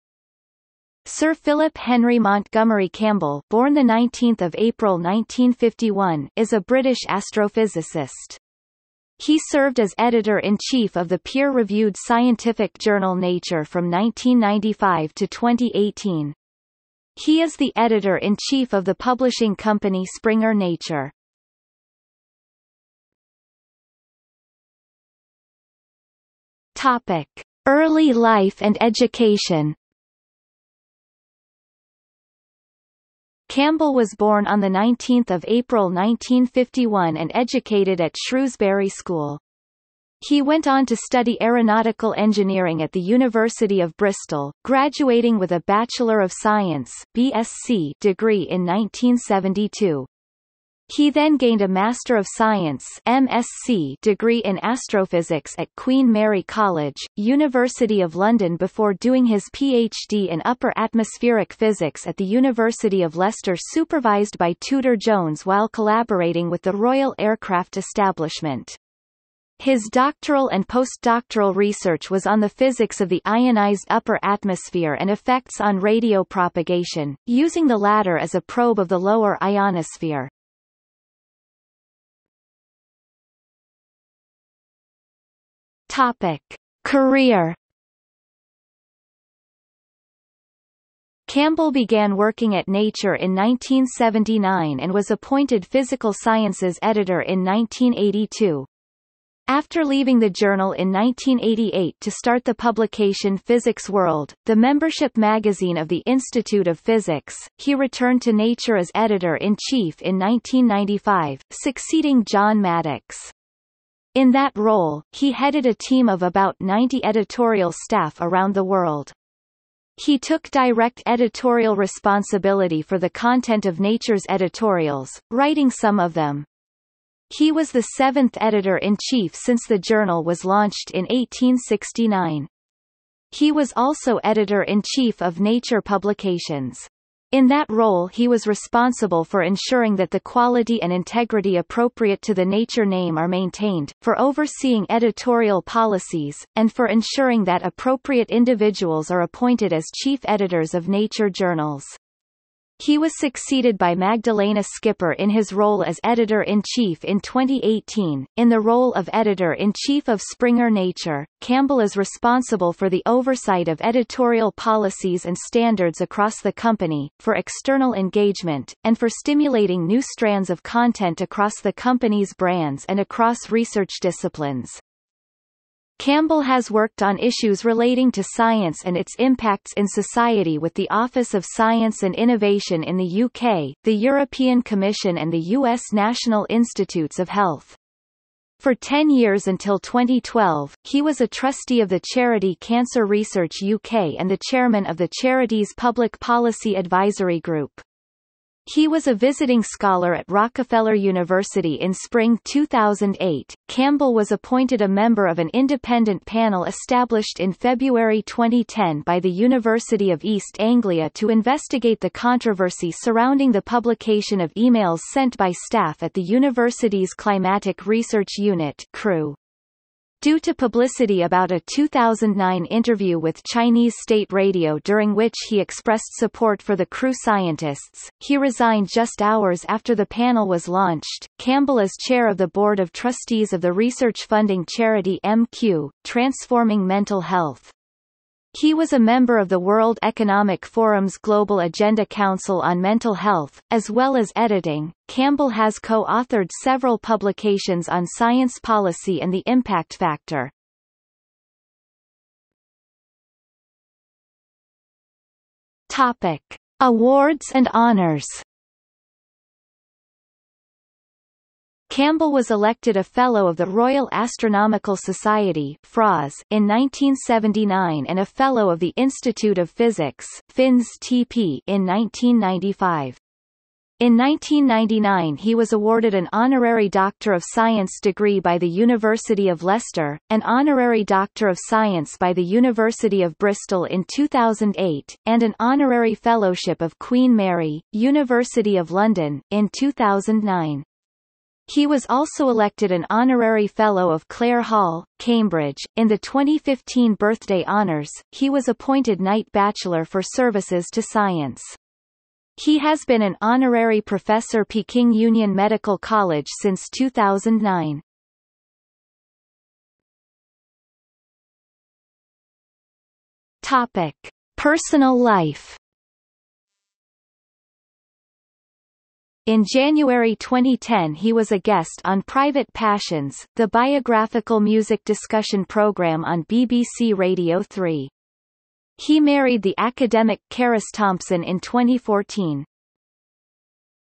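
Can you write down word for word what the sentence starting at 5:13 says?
Topic: Personal life In January 2010 he was a guest on Private Passions, the biographical music discussion program on BBC Radio 3.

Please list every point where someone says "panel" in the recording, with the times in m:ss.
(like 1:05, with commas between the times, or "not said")
3:26, 3:50.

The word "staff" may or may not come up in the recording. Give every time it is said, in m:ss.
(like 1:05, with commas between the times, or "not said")
1:57, 3:35.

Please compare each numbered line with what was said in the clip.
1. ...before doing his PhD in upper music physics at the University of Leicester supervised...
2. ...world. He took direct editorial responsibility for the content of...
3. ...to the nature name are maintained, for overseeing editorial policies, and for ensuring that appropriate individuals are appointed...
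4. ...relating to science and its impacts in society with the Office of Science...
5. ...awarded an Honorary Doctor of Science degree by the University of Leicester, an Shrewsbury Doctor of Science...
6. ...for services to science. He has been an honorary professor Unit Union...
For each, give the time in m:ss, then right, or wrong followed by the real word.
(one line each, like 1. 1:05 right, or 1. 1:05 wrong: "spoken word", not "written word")
1. 0:58 wrong: "atmospheric", not "music"
2. 1:58 right
3. 2:22 right
4. 2:57 right
5. 4:35 wrong: "Honorary", not "Shrewsbury"
6. 5:00 wrong: "Peking", not "Unit".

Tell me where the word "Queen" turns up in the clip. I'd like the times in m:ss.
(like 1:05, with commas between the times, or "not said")
0:55, 4:46.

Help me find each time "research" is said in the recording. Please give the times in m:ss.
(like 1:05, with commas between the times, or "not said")
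1:11, 2:53, 3:13, 3:37, 3:53.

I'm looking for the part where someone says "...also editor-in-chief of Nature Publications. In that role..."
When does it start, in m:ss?
2:13.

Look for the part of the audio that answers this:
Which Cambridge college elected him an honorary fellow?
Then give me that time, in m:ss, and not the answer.
4:54.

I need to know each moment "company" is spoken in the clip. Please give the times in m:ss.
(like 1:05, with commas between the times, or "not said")
0:19, 2:46, 2:51.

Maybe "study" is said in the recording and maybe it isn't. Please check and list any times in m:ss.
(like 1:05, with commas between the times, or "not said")
0:40.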